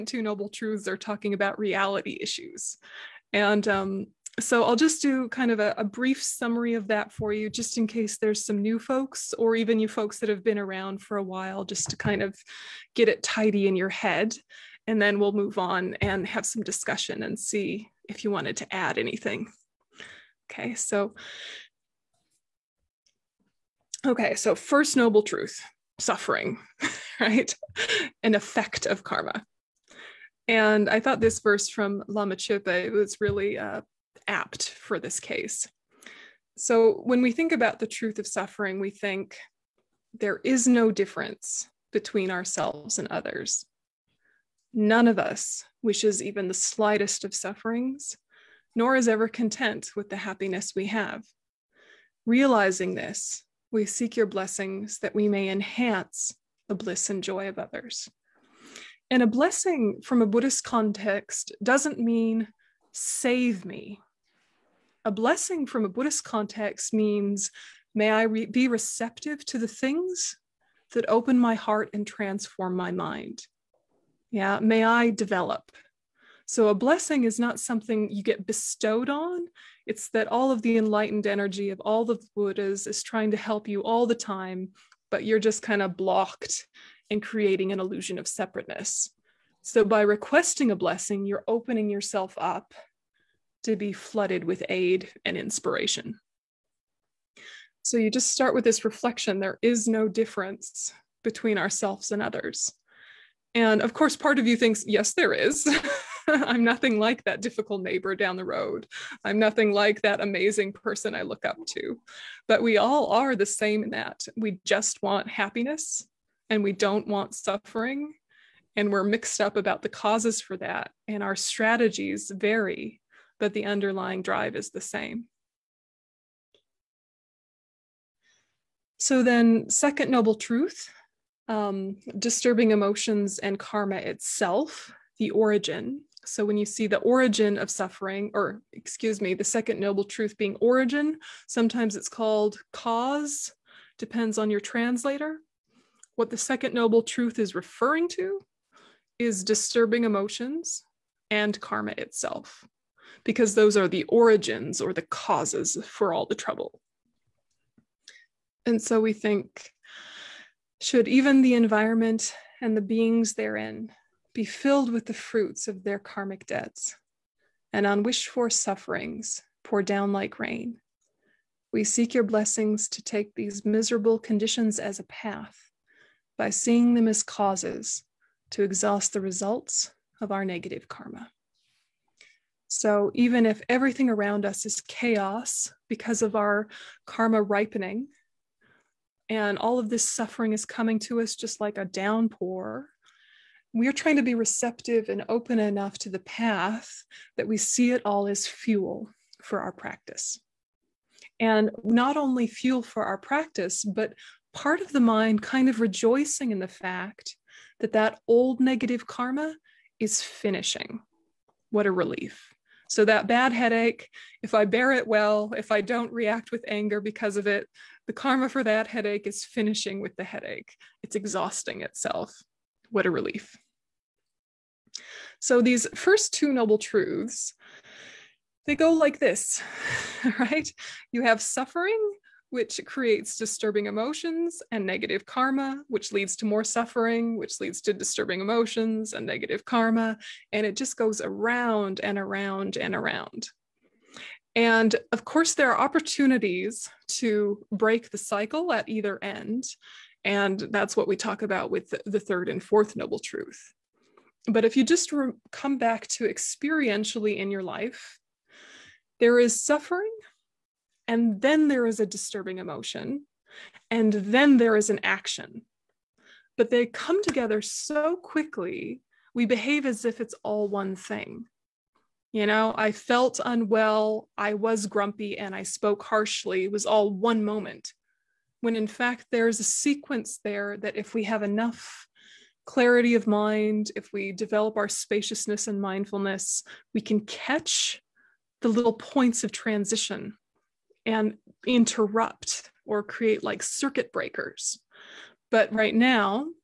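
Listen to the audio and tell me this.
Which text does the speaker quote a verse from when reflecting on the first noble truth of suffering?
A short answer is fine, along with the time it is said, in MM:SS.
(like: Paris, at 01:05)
Lama Chöpa, at 00:32.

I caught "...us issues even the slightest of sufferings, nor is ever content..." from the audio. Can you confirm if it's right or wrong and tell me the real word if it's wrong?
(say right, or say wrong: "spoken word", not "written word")
wrong: "wishes", not "issues".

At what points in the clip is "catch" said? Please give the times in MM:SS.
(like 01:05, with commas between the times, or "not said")
04:47.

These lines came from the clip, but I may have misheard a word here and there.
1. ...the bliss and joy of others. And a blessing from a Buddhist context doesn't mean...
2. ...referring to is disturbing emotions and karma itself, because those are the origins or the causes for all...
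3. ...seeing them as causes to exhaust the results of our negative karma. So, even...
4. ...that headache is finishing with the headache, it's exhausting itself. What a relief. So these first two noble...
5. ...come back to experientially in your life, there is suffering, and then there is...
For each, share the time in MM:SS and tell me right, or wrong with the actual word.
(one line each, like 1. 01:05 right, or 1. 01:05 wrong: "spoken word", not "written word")
1. 00:56 right
2. 02:27 right
3. 02:56 right
4. 03:38 right
5. 04:15 right.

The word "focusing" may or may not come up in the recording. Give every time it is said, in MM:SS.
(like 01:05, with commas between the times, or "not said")
not said.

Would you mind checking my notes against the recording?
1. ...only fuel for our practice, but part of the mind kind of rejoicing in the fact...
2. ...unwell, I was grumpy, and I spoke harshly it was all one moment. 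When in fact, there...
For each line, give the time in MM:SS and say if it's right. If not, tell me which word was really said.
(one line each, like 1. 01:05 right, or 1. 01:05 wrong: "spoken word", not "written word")
1. 03:22 right
2. 04:33 right.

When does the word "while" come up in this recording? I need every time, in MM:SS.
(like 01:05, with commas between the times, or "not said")
00:11.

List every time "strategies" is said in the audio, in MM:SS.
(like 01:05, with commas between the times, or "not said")
02:01.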